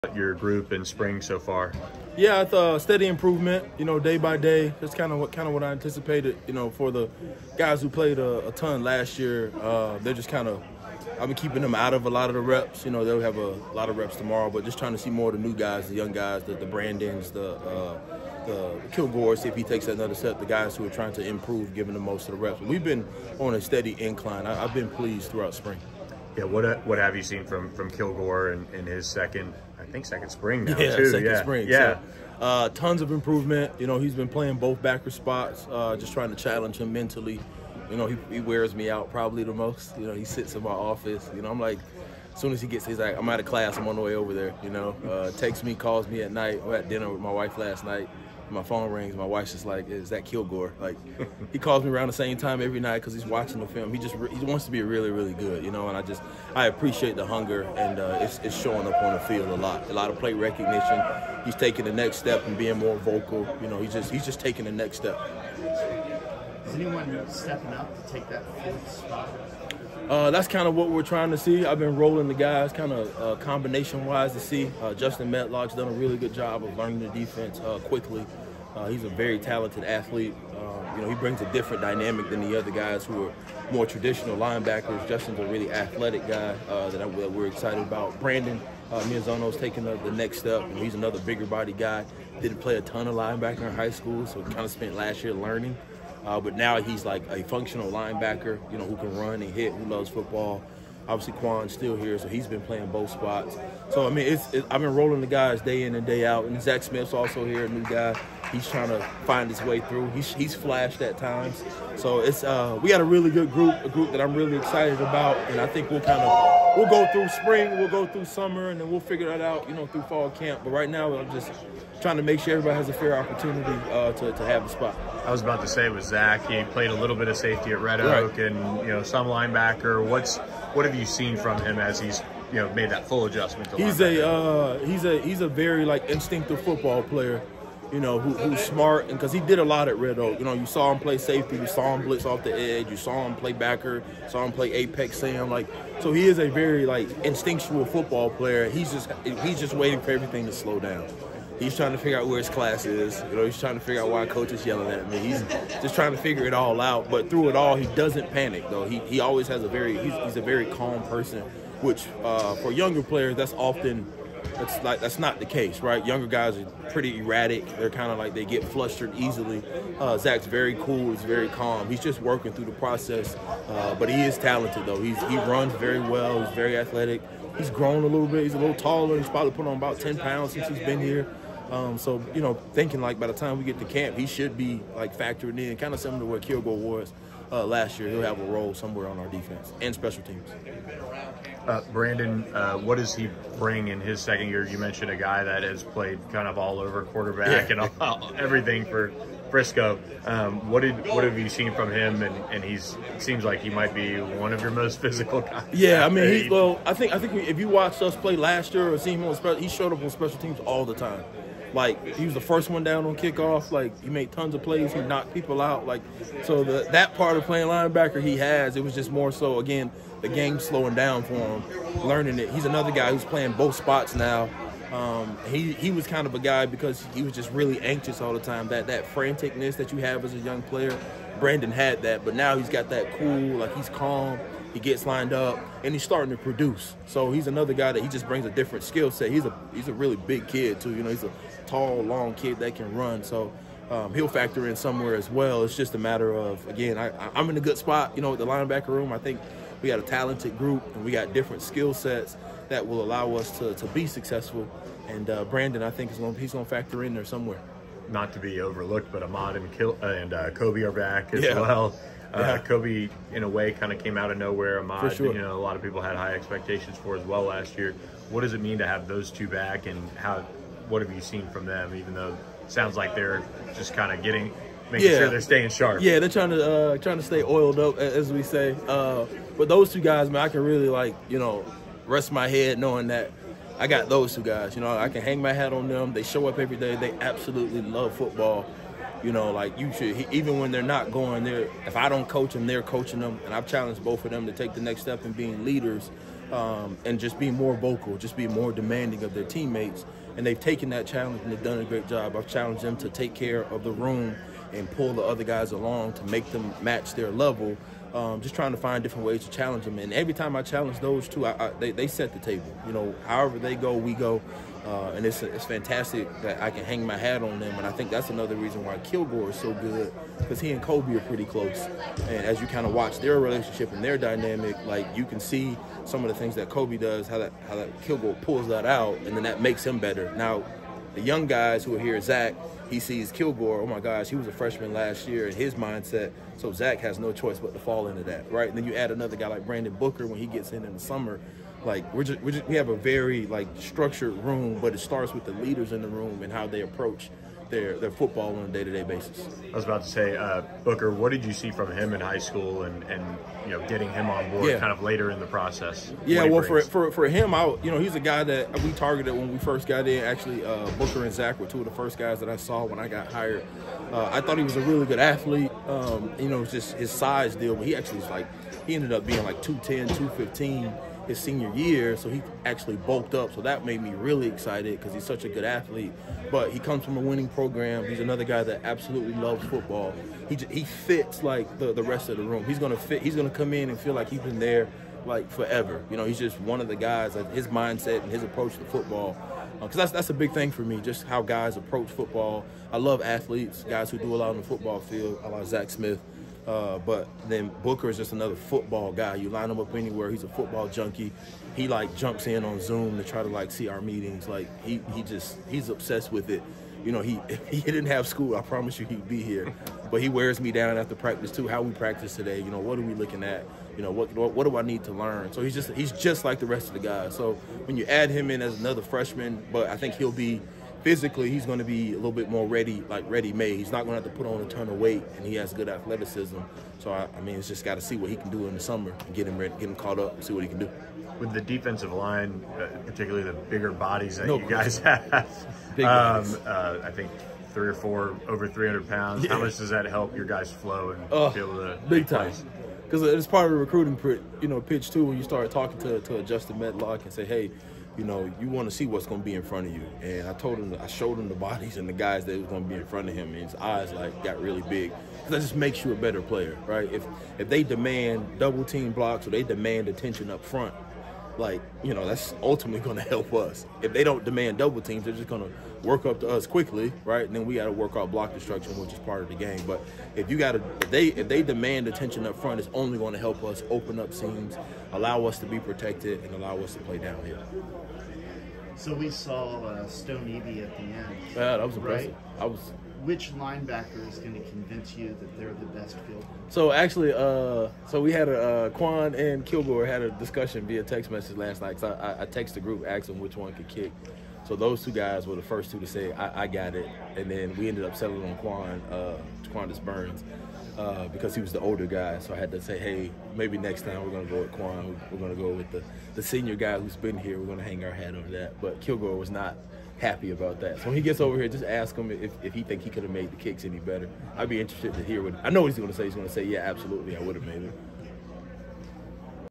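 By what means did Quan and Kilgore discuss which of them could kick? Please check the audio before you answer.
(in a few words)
text message.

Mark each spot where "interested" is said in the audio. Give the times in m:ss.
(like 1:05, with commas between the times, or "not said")
8:34.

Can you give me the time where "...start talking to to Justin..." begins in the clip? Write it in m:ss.
7:25.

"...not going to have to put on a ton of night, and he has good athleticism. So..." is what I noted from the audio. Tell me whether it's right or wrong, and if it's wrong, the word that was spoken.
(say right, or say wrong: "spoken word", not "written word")
wrong: "weight", not "night".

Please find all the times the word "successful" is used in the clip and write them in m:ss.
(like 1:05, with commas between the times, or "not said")
4:14.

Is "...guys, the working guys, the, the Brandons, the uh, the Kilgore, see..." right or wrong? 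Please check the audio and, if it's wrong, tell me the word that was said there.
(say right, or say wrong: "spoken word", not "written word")
wrong: "young", not "working".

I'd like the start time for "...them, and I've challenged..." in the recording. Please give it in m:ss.
4:53.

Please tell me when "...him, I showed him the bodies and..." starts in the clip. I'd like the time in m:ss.
7:30.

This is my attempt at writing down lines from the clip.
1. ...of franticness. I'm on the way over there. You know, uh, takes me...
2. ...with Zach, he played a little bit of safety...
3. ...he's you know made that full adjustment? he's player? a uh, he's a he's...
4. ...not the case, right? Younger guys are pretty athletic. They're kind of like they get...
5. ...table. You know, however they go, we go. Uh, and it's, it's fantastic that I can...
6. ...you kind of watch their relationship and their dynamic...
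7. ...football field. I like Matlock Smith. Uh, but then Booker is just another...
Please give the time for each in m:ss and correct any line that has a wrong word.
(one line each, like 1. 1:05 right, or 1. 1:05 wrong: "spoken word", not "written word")
1. 0:43 wrong: "class", not "franticness"
2. 2:05 right
3. 2:12 wrong: "linebacker", not "player"
4. 2:45 wrong: "erratic", not "athletic"
5. 5:12 right
6. 5:22 right
7. 6:34 wrong: "Zach", not "Matlock".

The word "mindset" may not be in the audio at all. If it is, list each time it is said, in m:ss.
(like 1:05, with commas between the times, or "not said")
5:35, 6:27.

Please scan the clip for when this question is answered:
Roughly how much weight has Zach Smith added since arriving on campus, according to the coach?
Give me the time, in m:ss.
2:59.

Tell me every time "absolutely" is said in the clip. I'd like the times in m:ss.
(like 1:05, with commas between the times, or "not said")
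4:47, 6:18, 8:36.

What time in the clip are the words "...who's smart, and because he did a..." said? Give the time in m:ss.
2:18.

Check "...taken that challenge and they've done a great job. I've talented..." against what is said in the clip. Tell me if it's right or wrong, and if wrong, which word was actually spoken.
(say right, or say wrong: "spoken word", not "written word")
wrong: "challenged", not "talented".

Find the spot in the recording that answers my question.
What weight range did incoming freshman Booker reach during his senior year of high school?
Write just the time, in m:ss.
6:09.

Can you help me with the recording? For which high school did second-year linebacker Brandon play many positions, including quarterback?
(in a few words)
Briscoe.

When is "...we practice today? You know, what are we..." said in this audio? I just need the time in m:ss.
6:51.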